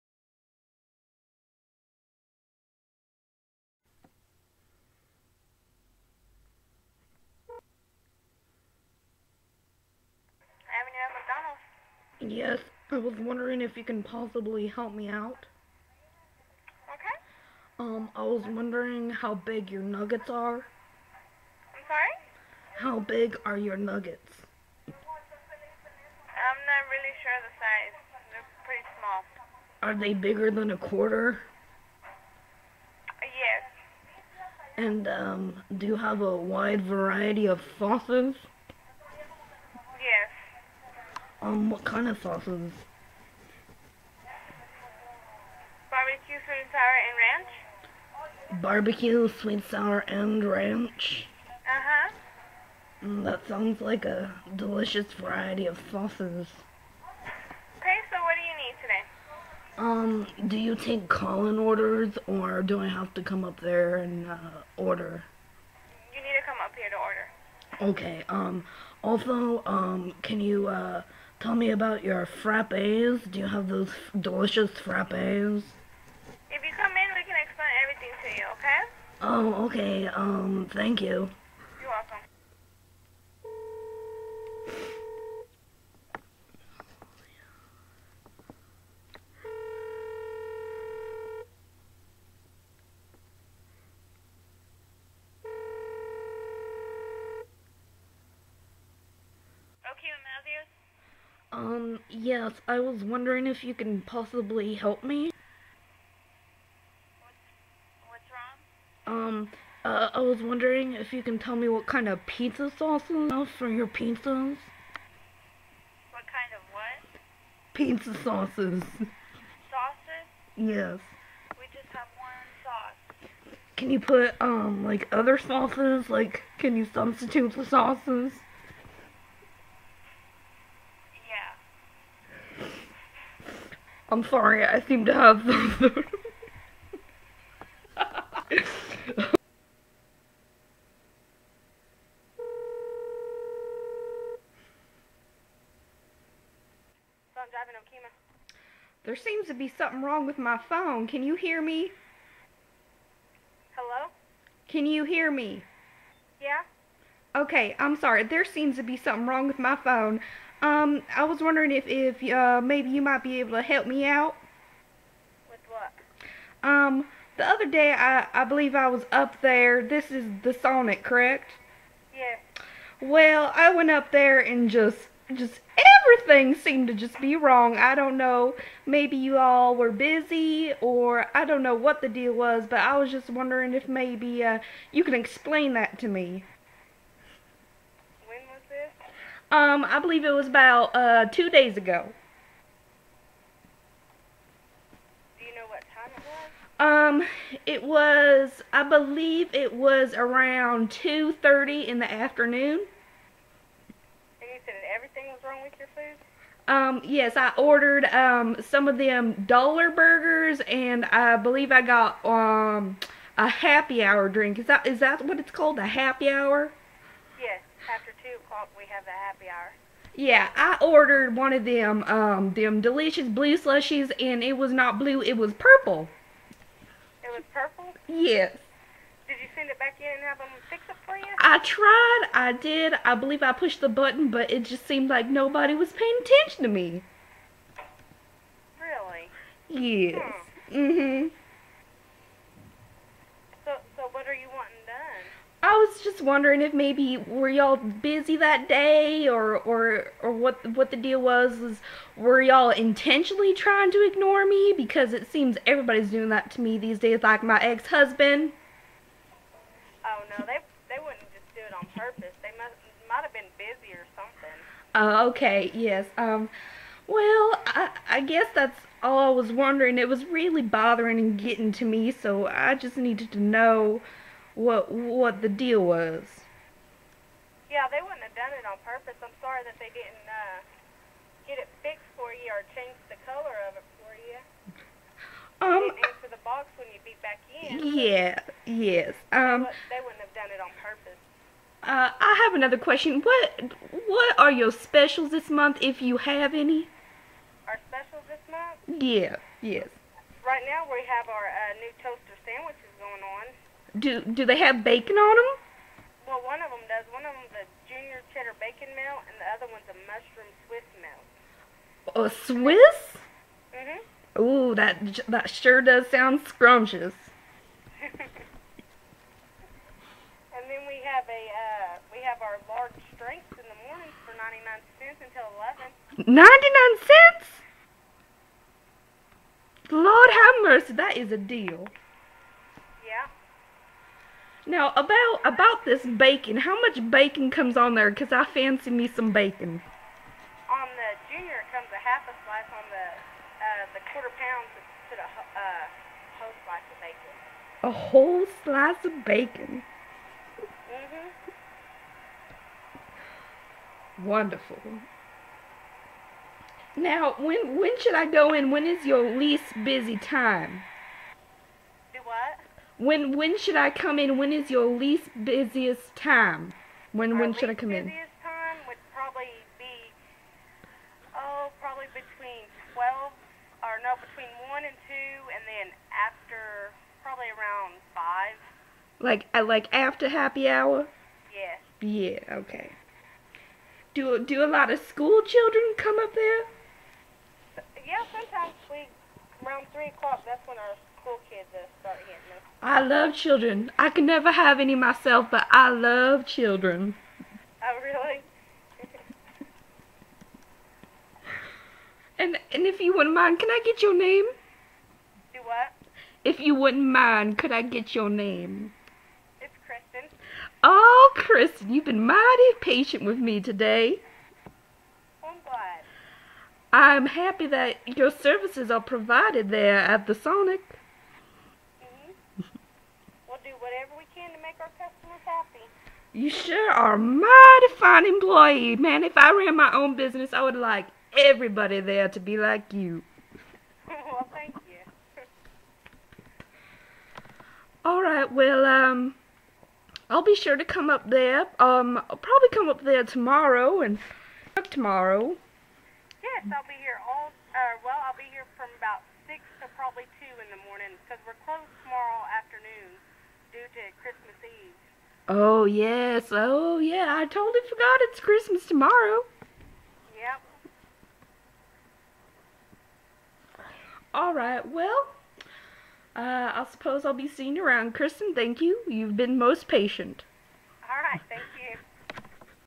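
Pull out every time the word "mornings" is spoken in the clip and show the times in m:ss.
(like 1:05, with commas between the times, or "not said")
5:23, 7:30.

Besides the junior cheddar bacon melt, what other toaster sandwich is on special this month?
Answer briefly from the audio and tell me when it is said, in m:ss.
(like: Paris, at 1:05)
mushroom Swiss melt, at 5:10.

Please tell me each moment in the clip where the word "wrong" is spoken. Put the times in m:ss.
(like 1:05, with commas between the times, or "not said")
1:49, 2:30, 2:39, 2:57, 3:25.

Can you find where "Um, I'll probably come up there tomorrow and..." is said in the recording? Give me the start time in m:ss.
7:21.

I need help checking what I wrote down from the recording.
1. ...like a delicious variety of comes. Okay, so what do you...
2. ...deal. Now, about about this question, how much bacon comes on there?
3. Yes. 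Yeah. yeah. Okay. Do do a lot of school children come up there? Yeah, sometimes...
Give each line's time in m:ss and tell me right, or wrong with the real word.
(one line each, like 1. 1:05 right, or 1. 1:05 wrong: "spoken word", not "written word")
1. 0:53 wrong: "sauces", not "comes"
2. 5:31 wrong: "bacon", not "question"
3. 6:21 right.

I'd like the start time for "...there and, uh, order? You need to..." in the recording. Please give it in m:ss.
1:03.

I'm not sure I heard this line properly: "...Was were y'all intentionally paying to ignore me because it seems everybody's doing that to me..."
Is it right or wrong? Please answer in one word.
wrong.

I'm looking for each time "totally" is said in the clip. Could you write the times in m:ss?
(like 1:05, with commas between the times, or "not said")
7:37.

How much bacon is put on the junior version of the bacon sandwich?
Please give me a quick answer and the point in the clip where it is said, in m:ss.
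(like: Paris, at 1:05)
half a slice, at 5:41.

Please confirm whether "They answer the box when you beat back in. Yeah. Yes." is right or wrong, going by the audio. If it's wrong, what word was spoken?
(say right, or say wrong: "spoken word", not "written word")
right.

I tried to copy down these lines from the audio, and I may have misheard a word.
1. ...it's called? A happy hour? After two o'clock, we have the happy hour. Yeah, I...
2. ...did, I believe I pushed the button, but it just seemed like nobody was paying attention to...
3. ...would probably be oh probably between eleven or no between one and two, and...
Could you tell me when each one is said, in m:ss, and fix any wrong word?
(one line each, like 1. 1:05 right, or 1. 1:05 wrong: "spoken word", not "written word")
1. 3:35 right
2. 3:52 right
3. 6:08 wrong: "twelve", not "eleven".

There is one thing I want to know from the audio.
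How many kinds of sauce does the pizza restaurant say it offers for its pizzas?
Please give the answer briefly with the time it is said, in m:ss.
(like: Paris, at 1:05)
1, at 2:02.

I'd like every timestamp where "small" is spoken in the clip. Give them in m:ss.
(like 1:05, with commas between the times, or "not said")
0:29.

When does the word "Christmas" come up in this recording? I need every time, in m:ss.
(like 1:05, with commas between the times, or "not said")
7:34, 7:38.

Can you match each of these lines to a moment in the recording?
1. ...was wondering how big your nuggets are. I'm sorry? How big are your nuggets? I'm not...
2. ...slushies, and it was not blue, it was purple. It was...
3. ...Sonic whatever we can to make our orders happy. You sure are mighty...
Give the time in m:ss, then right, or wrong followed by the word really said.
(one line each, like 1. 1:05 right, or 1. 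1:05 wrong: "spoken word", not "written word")
1. 0:18 right
2. 3:43 right
3. 7:00 wrong: "customers", not "orders".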